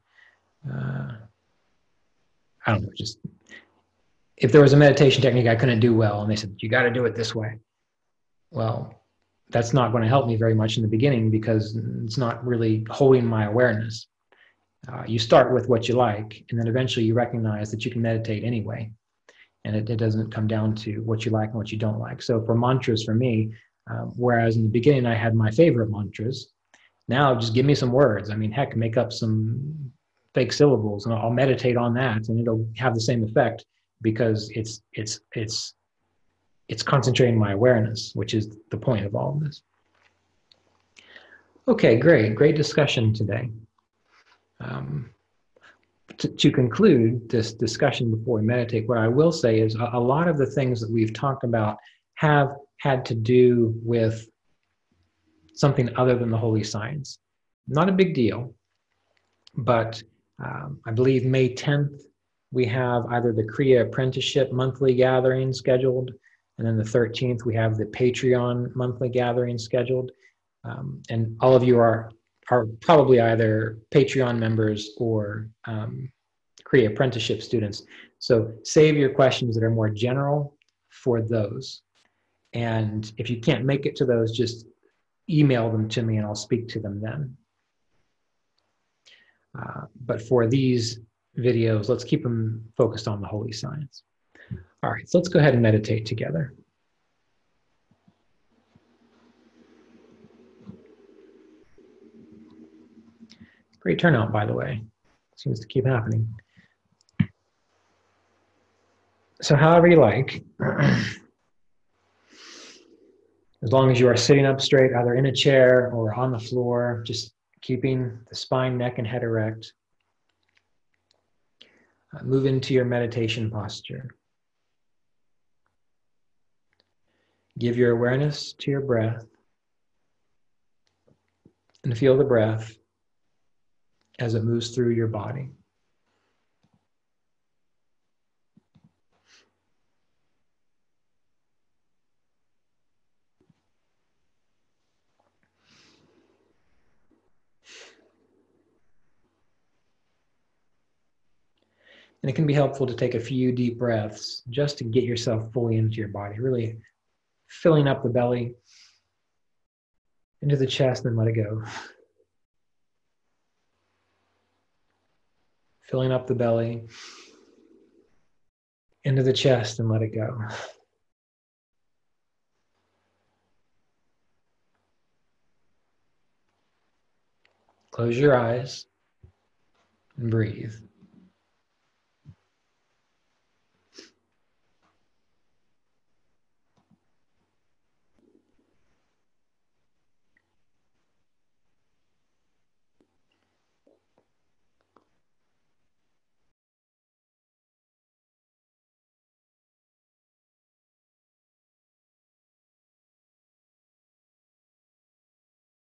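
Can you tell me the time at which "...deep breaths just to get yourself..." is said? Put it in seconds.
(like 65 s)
153 s.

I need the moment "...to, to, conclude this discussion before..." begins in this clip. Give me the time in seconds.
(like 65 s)
46 s.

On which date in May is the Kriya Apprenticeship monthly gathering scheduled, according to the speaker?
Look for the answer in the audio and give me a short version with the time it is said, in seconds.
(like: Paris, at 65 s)
May 10, at 61 s.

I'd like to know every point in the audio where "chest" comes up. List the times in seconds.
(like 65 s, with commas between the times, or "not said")
160 s, 169 s.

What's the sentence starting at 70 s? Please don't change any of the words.
Um, and all of you are, are probably either Patreon members or um, Apprenticeship students.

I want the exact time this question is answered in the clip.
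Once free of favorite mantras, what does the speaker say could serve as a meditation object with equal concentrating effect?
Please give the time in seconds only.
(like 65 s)
30 s.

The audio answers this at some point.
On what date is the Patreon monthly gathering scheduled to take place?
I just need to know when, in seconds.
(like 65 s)
66 s.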